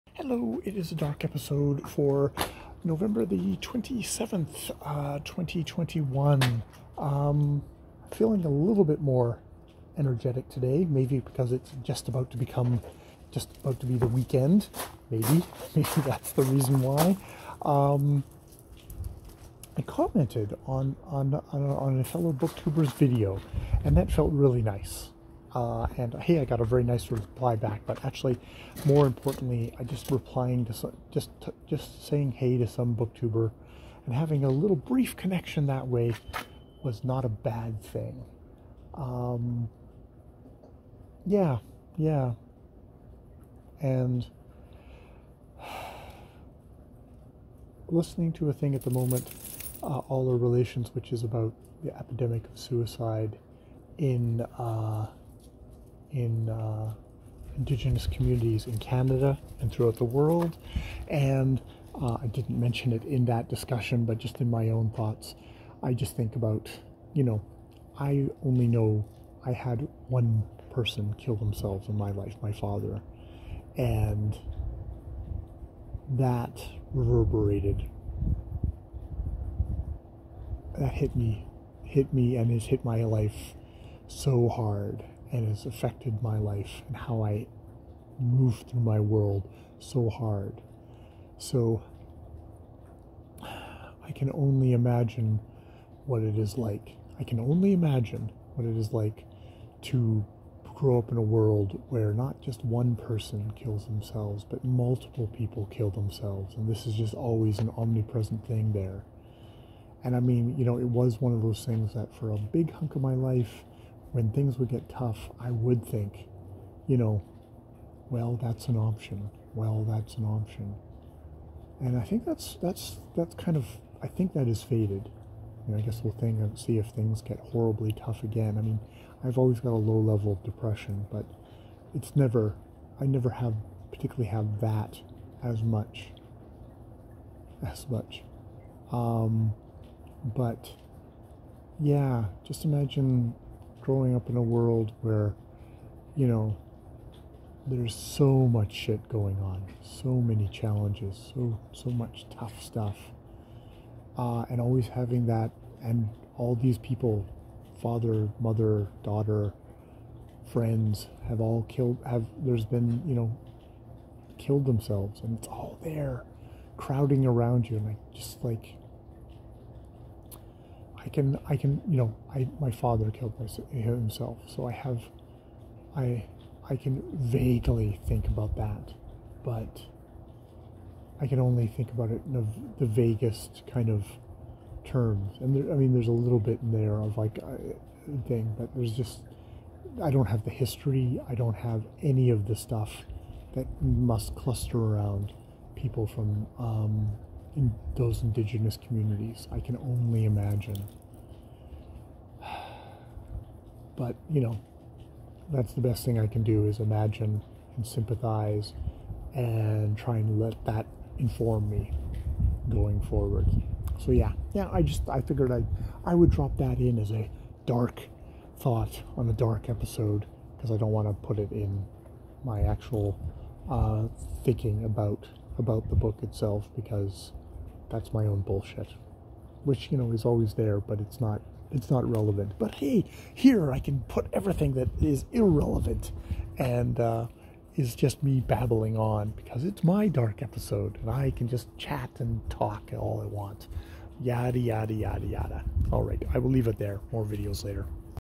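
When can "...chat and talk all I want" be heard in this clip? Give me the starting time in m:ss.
4:01.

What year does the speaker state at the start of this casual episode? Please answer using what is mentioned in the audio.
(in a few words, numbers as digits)
2021.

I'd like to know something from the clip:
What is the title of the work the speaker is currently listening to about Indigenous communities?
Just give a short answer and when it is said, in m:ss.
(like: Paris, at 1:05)
All Our Relations, at 0:49.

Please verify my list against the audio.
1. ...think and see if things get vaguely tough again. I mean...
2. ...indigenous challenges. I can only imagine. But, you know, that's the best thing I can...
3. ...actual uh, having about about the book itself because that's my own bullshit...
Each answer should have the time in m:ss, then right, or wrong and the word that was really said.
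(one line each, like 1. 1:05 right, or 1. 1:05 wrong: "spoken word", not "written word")
1. 2:06 wrong: "horribly", not "vaguely"
2. 3:18 wrong: "communities", not "challenges"
3. 3:42 wrong: "thinking", not "having".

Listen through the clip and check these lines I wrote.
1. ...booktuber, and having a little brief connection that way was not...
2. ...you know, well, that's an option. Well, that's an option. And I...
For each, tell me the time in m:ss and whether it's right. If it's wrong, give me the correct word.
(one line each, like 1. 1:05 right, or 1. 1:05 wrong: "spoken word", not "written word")
1. 0:32 right
2. 1:56 right.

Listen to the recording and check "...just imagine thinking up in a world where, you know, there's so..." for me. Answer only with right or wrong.
wrong.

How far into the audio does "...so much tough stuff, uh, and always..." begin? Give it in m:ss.
2:31.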